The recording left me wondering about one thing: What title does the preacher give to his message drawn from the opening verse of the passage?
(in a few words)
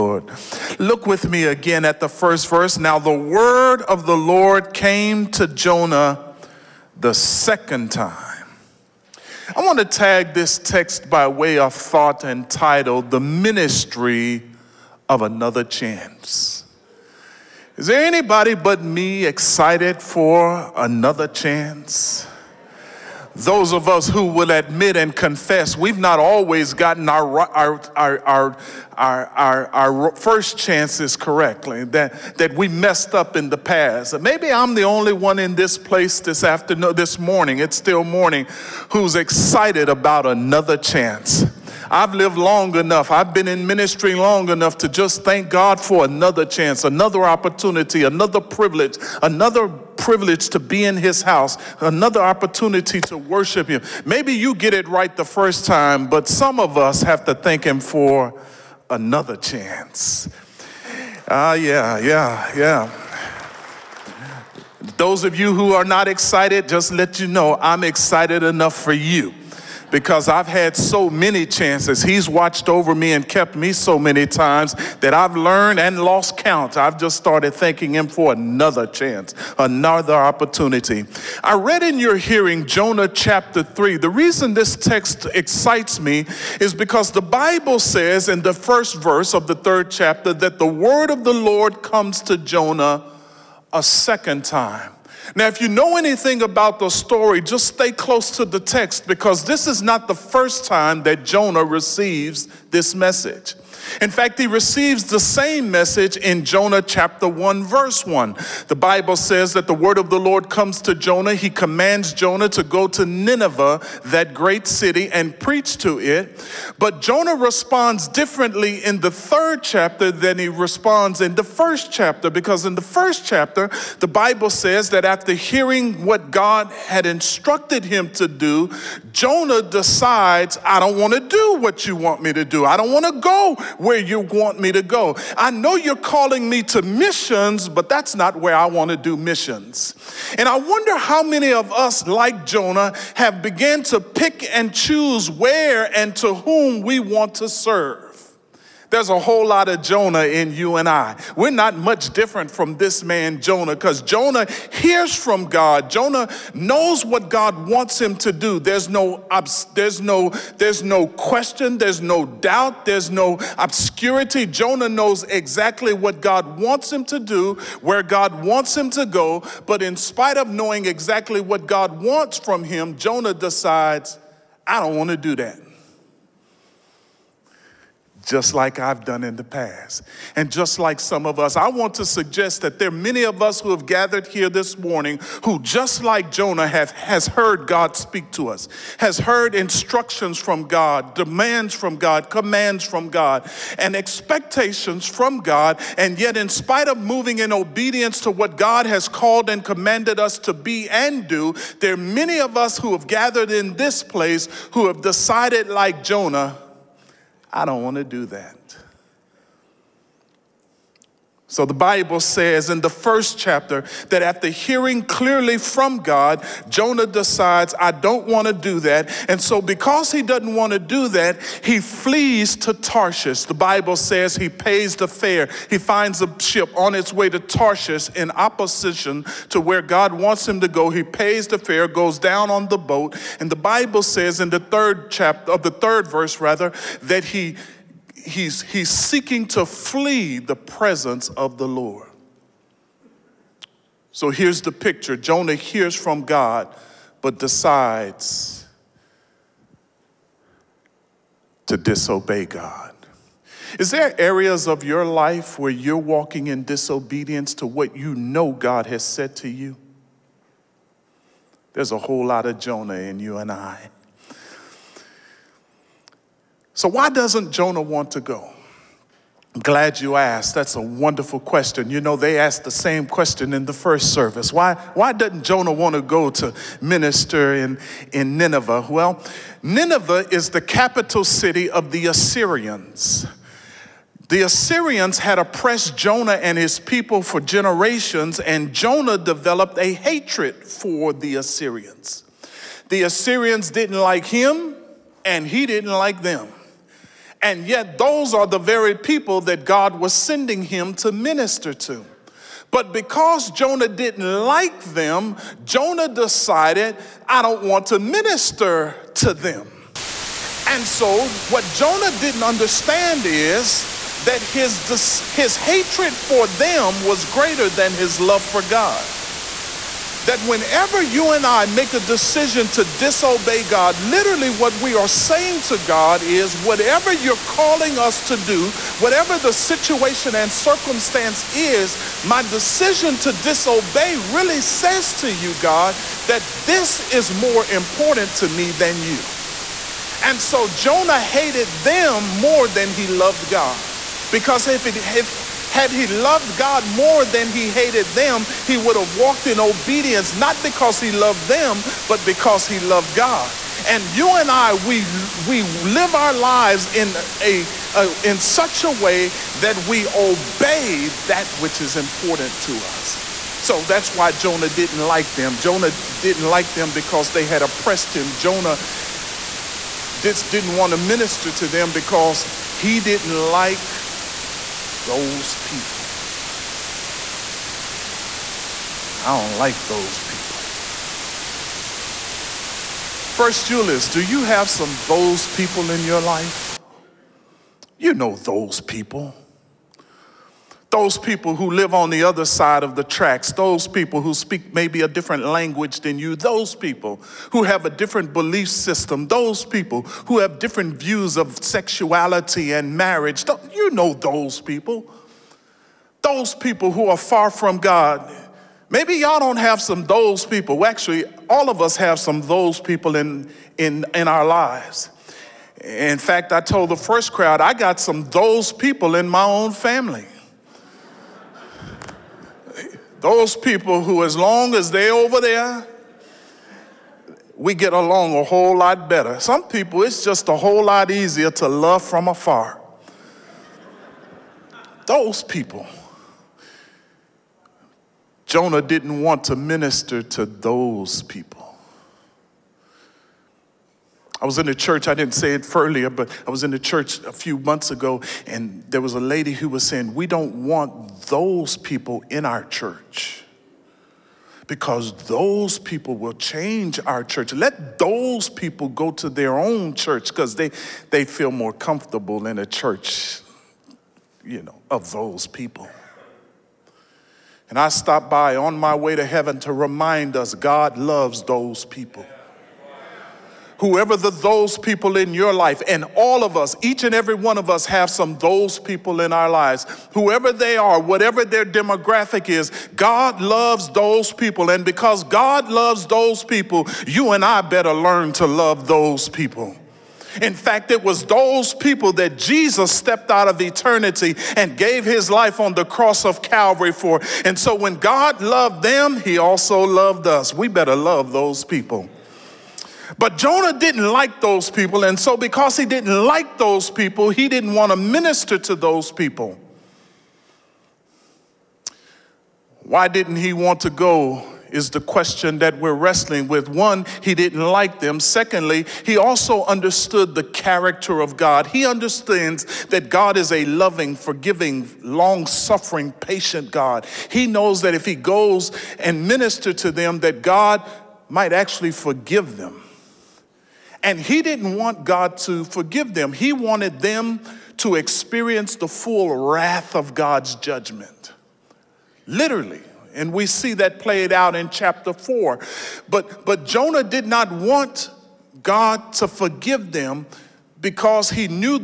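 The Ministry of Another Chance.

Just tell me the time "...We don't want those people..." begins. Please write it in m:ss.
7:30.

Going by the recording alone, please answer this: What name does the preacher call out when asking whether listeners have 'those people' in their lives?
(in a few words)
Julius.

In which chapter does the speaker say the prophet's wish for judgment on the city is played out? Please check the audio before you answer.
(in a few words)
Chapter 4.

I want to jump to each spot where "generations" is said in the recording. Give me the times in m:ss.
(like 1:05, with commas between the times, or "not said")
4:47.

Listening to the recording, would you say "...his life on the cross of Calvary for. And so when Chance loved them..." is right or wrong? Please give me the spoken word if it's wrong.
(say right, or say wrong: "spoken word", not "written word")
wrong: "God", not "Chance".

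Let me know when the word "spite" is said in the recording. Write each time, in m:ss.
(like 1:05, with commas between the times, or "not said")
2:49, 3:16.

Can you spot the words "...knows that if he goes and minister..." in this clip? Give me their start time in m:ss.
8:47.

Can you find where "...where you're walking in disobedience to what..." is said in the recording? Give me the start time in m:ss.
4:15.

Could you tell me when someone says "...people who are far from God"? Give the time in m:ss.
6:46.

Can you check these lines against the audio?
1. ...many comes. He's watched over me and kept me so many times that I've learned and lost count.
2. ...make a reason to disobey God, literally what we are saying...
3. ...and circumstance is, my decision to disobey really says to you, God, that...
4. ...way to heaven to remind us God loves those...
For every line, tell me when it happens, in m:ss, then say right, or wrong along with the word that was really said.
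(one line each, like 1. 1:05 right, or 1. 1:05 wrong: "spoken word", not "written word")
1. 1:11 wrong: "chances", not "comes"
2. 5:21 wrong: "decision", not "reason"
3. 5:30 right
4. 7:48 right.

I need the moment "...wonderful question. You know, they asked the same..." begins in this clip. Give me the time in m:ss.
4:30.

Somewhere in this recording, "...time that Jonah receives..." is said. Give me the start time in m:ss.
1:40.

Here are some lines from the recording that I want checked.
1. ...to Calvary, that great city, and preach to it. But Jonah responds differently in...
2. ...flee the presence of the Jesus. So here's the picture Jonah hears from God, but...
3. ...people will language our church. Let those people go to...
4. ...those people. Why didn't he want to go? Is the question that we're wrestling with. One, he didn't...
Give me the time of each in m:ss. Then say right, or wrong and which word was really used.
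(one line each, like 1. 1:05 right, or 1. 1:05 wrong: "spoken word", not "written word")
1. 1:52 wrong: "Nineveh", not "Calvary"
2. 3:59 wrong: "Lord", not "Jesus"
3. 7:35 wrong: "change", not "language"
4. 8:28 right.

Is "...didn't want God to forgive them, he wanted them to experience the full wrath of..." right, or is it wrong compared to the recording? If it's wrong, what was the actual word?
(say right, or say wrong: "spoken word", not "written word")
right.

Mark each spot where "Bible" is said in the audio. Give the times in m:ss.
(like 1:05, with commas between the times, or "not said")
1:27, 1:48, 2:04, 3:31, 3:43, 3:53.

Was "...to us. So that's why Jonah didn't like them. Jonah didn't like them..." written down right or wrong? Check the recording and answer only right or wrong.
right.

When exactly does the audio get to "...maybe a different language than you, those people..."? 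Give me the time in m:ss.
6:34.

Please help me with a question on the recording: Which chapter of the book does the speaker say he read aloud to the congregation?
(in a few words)
Jonah chapter 3.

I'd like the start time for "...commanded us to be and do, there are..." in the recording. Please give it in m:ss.
3:19.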